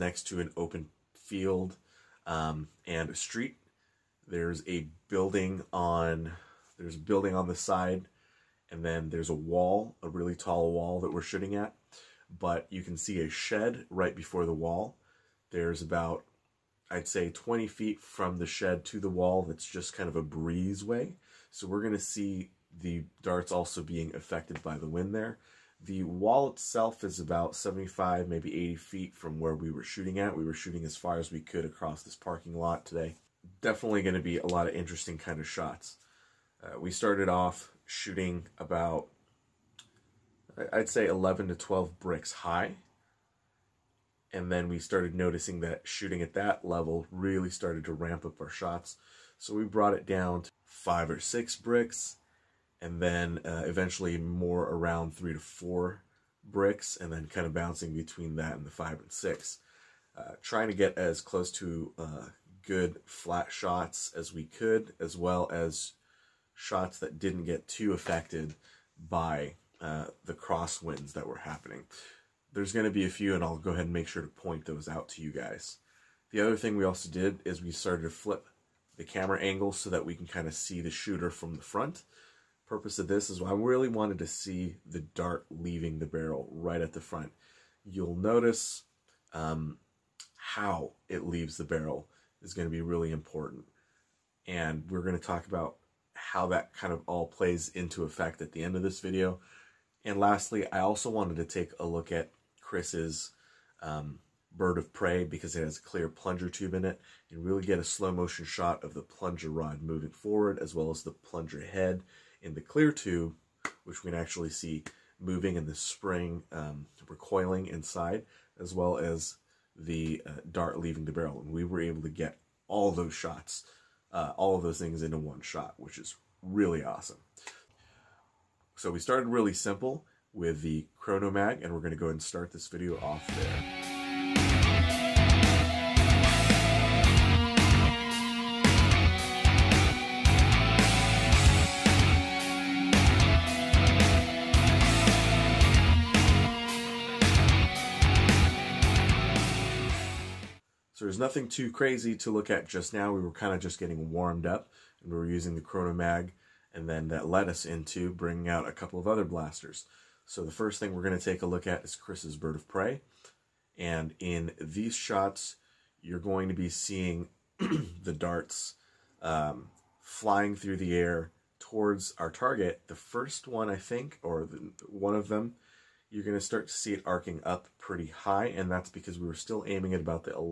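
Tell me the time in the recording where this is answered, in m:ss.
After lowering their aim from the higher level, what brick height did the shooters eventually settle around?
0:55.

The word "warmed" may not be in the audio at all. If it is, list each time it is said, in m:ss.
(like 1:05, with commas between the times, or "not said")
2:34.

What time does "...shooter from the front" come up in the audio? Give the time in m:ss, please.
1:20.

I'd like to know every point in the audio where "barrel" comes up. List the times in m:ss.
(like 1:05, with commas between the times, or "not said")
1:26, 1:31, 2:01.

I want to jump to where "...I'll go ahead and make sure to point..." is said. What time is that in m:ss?
1:13.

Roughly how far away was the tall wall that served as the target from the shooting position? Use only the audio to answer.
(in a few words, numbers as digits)
75 to 80 feet.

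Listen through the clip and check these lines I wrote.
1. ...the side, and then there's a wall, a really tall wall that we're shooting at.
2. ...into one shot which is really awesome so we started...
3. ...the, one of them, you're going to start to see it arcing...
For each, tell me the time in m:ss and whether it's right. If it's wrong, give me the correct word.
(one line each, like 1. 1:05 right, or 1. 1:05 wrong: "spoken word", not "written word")
1. 0:07 right
2. 2:05 right
3. 2:54 right.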